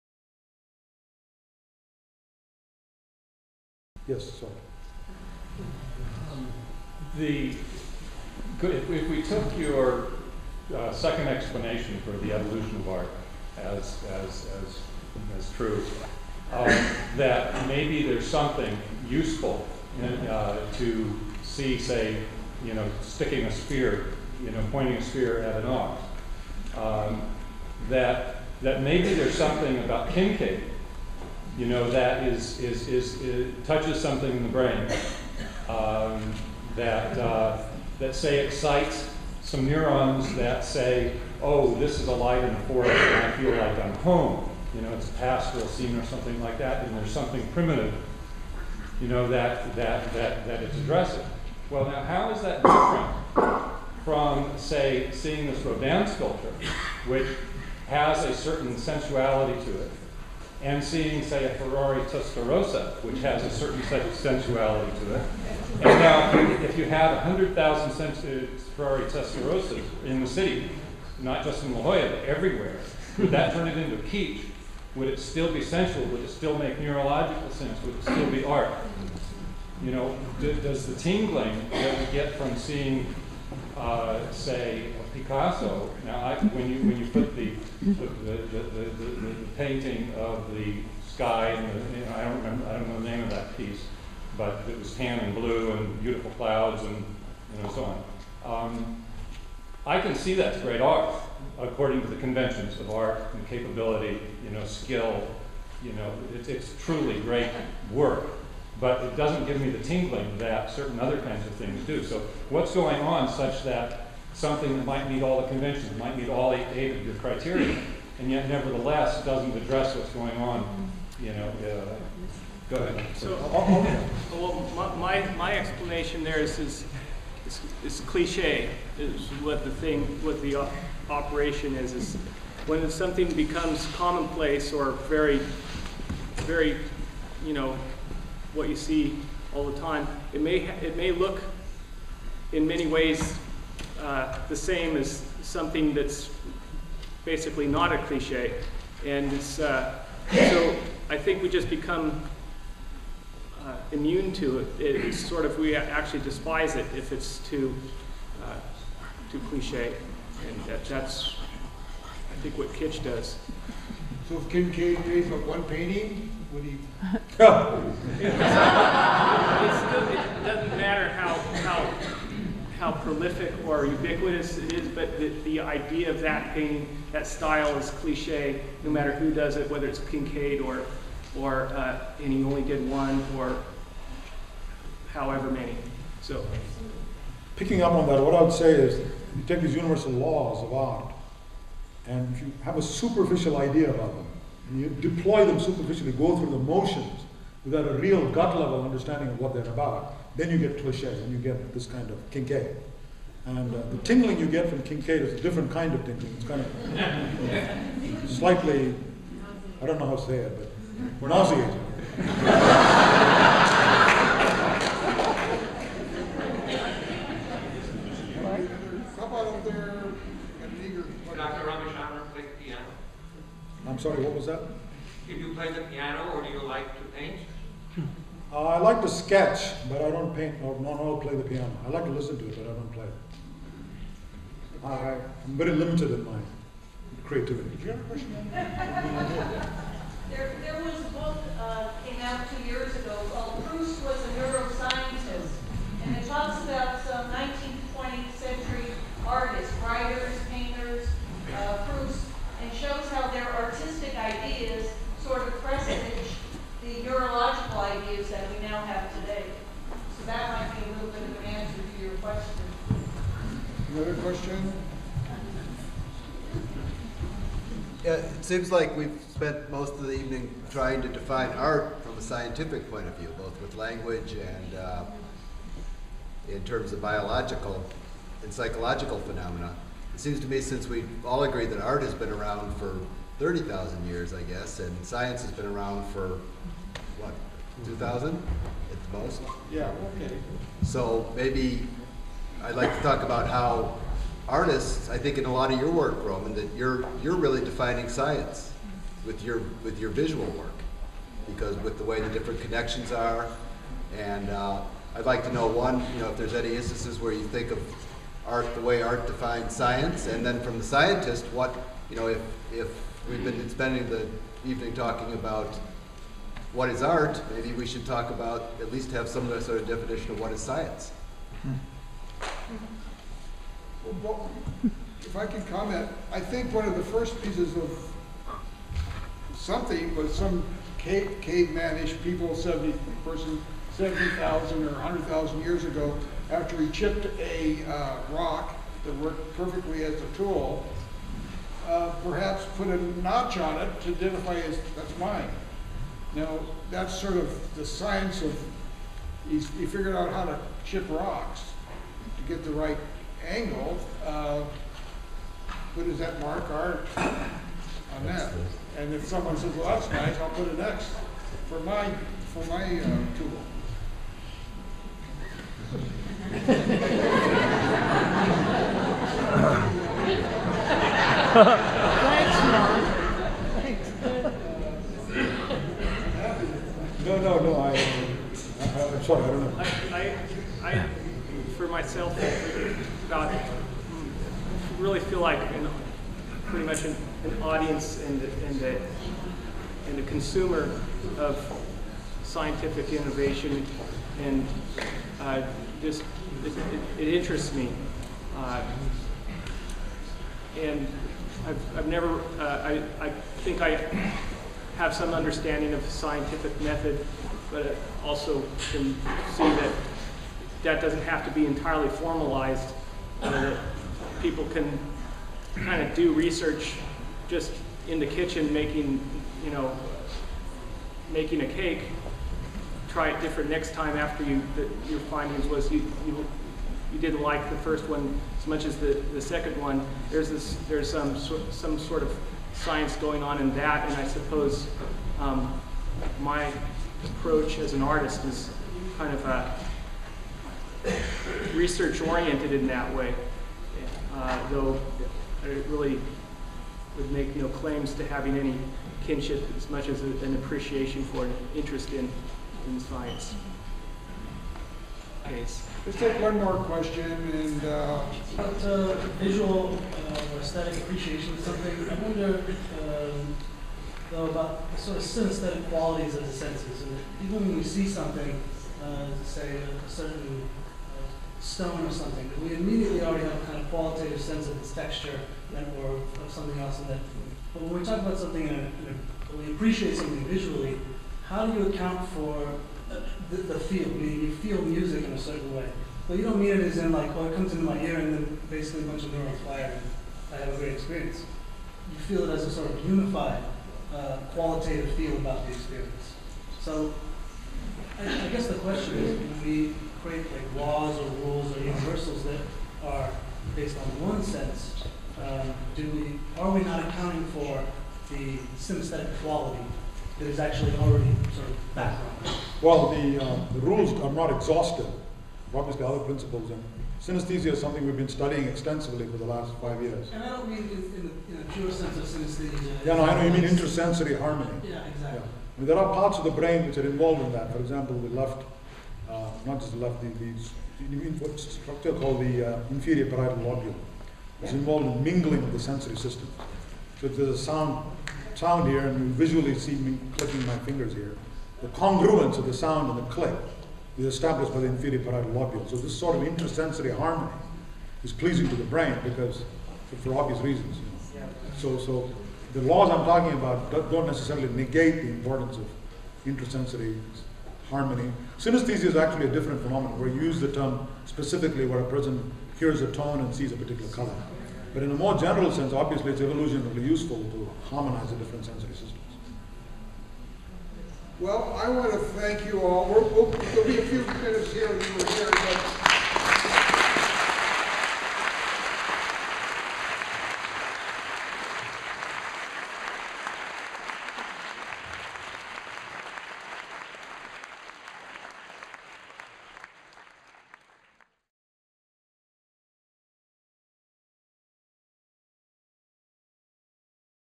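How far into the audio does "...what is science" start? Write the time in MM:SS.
05:20.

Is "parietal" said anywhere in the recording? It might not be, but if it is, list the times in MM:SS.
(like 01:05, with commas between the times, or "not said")
08:53, 09:05.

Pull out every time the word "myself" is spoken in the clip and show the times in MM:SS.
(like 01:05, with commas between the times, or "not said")
06:22.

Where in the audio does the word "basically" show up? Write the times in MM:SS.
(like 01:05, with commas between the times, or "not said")
02:27, 08:08.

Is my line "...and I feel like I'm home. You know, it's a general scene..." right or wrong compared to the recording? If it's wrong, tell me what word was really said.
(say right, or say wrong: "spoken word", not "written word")
wrong: "pastoral", not "general".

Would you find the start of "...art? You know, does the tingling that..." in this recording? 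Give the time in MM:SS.
01:18.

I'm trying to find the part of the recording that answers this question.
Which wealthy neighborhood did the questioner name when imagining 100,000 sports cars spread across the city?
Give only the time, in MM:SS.
01:11.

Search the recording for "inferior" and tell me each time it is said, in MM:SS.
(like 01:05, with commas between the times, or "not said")
08:52, 09:04.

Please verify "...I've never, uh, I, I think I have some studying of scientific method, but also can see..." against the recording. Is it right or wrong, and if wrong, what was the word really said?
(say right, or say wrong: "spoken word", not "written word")
wrong: "understanding", not "studying".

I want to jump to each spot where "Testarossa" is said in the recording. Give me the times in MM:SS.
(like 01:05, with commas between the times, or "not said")
01:02, 01:09.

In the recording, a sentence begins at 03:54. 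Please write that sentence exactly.
I, am very limited in my creativity.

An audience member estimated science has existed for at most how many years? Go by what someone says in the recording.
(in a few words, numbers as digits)
2,000.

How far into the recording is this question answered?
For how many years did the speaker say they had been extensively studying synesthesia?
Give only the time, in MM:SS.
08:39.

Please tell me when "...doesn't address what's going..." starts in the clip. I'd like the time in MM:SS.
01:59.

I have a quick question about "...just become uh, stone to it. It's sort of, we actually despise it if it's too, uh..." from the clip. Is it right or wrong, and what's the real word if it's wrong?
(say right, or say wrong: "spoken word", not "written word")
wrong: "immune", not "stone".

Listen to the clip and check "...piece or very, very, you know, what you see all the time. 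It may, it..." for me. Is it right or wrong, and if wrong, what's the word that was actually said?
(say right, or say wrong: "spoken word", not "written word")
wrong: "commonplace", not "piece".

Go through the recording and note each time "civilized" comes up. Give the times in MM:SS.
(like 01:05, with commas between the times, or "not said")
not said.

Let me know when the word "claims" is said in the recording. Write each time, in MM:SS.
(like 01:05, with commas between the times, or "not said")
07:27.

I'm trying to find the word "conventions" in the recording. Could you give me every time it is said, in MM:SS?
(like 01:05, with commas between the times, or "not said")
01:42, 01:55.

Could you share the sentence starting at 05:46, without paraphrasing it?
Now, that's sort of the science of, he figured out how to chip rocks to get the right angle.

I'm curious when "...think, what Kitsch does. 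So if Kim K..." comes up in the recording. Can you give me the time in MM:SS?
02:42.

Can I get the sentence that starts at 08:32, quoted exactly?
Well, the, um, the rules are not exhaustive.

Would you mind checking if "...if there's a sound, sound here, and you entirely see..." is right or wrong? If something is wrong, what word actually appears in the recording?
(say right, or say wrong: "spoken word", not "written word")
wrong: "visually", not "entirely".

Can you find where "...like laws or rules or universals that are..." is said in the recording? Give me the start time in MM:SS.
08:20.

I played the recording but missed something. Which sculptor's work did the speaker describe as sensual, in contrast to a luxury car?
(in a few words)
Rodin.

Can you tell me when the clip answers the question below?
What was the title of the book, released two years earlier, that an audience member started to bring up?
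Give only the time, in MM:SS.
04:03.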